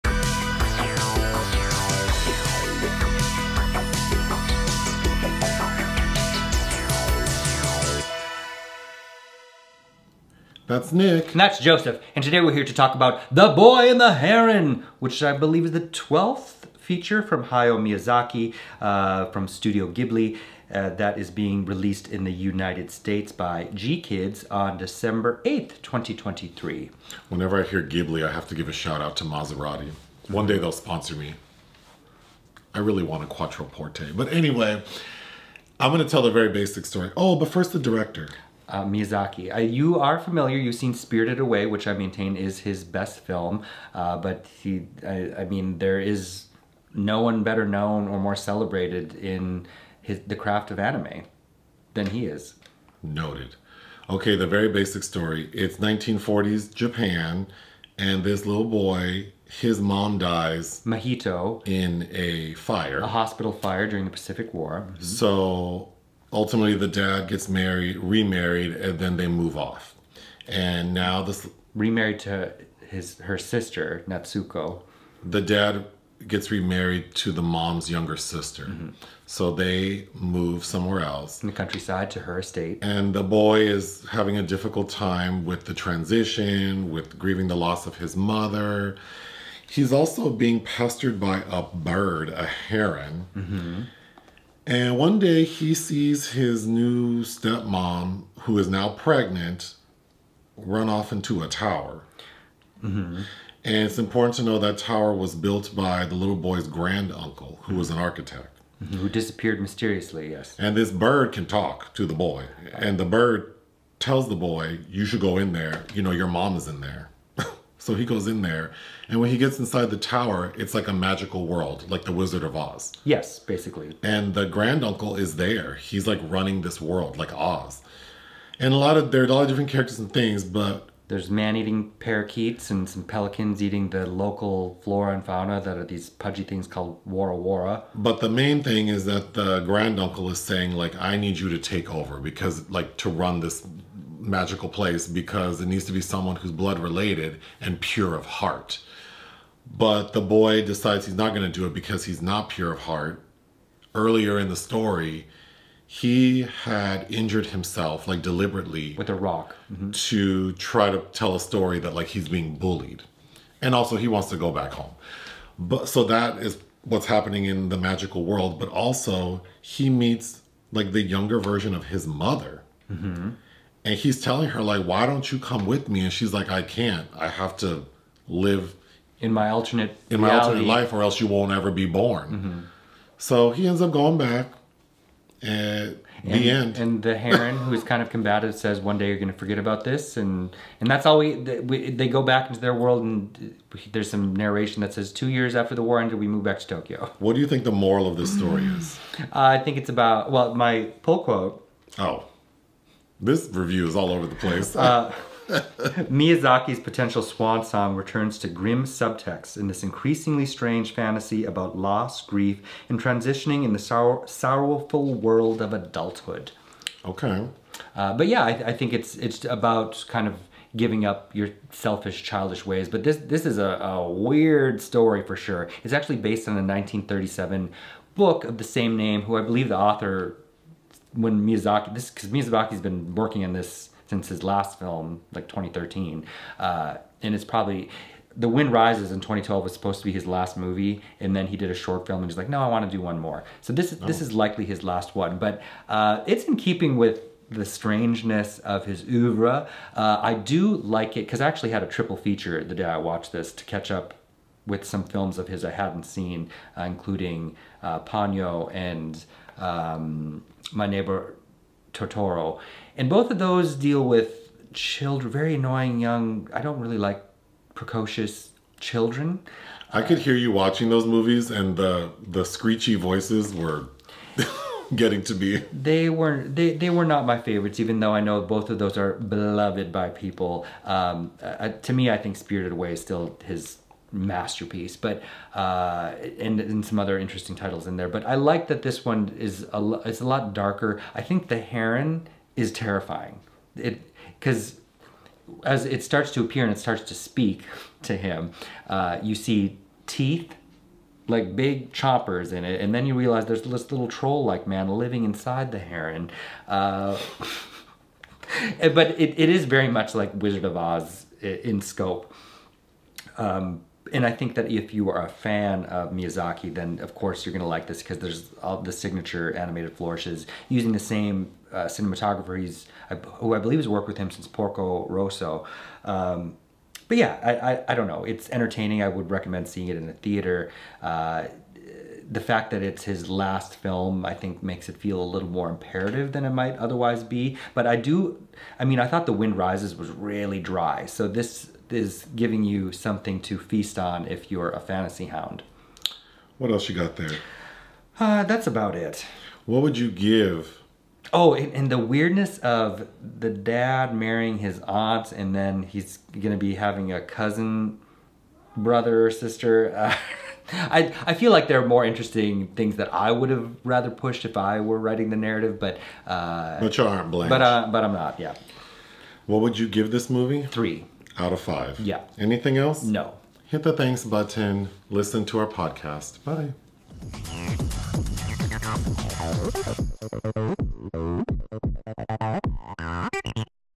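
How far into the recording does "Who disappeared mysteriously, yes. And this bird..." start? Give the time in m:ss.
1:48.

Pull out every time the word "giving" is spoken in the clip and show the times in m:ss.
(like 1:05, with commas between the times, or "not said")
3:40, 5:42.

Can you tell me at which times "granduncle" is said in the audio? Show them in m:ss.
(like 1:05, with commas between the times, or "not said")
1:46, 2:04, 2:19.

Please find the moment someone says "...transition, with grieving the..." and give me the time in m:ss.
1:25.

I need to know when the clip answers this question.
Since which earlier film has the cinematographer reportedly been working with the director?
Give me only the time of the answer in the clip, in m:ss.
5:24.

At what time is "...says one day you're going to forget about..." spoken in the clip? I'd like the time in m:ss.
3:08.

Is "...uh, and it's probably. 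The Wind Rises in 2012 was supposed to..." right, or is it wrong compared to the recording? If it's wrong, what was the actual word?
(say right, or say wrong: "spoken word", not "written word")
right.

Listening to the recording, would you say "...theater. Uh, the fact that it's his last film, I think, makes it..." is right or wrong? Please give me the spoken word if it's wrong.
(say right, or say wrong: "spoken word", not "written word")
right.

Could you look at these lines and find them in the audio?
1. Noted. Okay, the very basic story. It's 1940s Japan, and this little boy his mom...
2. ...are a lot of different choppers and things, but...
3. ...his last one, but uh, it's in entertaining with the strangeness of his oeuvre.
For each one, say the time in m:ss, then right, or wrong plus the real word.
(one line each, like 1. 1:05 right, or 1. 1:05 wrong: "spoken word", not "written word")
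1. 0:53 right
2. 2:09 wrong: "characters", not "choppers"
3. 4:04 wrong: "keeping", not "entertaining".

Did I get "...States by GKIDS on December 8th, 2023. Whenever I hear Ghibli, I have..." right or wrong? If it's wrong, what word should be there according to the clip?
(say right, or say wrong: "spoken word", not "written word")
right.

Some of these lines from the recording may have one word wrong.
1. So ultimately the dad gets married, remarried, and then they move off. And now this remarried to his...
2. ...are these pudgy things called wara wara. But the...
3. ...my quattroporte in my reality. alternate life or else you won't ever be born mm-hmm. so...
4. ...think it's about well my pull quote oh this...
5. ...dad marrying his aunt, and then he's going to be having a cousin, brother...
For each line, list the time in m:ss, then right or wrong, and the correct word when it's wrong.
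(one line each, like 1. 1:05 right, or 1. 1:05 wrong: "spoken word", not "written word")
1. 1:05 right
2. 2:15 right
3. 2:59 wrong: "alternate", not "quattroporte"
4. 3:19 right
5. 5:53 right.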